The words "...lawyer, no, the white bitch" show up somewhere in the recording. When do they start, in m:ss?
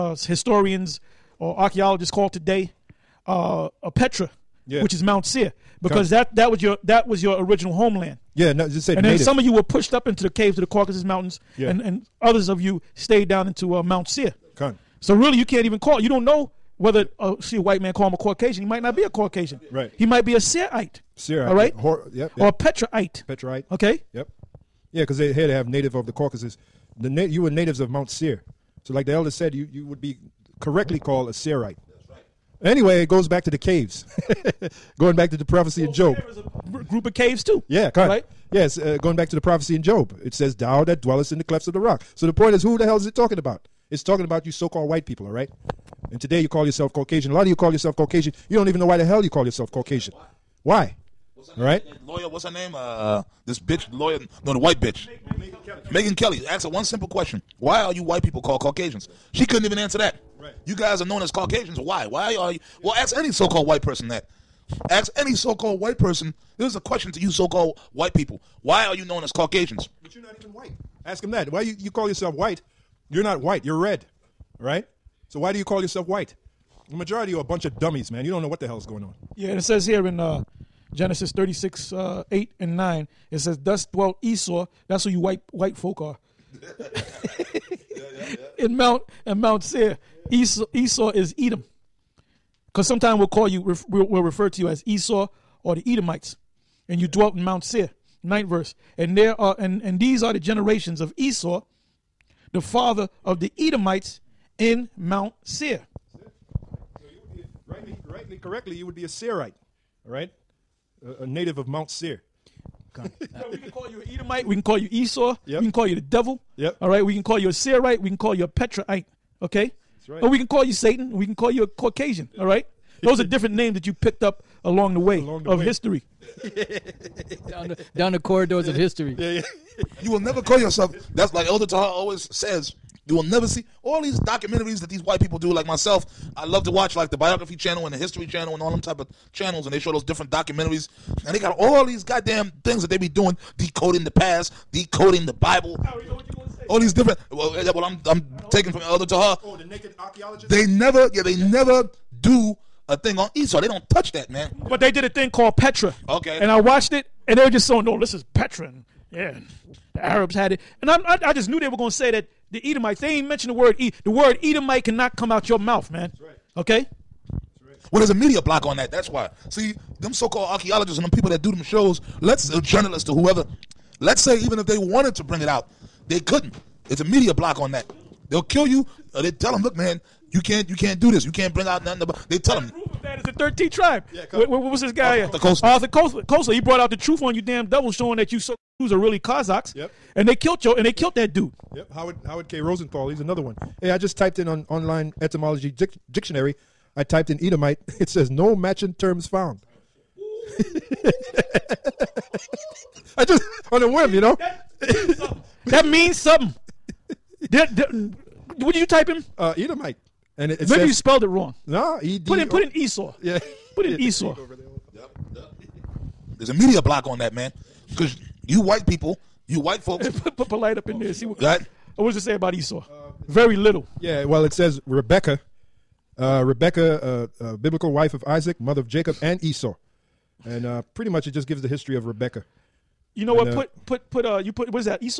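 0:53.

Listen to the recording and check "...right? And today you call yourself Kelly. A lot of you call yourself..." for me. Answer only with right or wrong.
wrong.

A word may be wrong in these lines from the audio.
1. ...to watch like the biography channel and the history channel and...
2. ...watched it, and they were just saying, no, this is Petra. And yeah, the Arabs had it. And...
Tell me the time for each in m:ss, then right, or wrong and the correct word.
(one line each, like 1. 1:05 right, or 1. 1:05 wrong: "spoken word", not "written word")
1. 2:16 right
2. 2:36 right.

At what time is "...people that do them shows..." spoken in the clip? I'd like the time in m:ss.
2:51.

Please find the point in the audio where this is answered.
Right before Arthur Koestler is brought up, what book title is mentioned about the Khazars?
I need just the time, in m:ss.
3:03.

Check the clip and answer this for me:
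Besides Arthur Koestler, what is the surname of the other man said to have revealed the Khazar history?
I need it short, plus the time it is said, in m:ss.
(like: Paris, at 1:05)
Rosenthal, at 3:12.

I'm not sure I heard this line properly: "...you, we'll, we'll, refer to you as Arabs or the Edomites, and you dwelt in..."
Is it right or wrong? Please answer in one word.
wrong.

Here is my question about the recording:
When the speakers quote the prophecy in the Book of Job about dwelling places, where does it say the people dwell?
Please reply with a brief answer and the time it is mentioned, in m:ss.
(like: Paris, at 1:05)
the clefts of the rock, at 0:41.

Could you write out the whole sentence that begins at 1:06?
This is a question to you so-called white people.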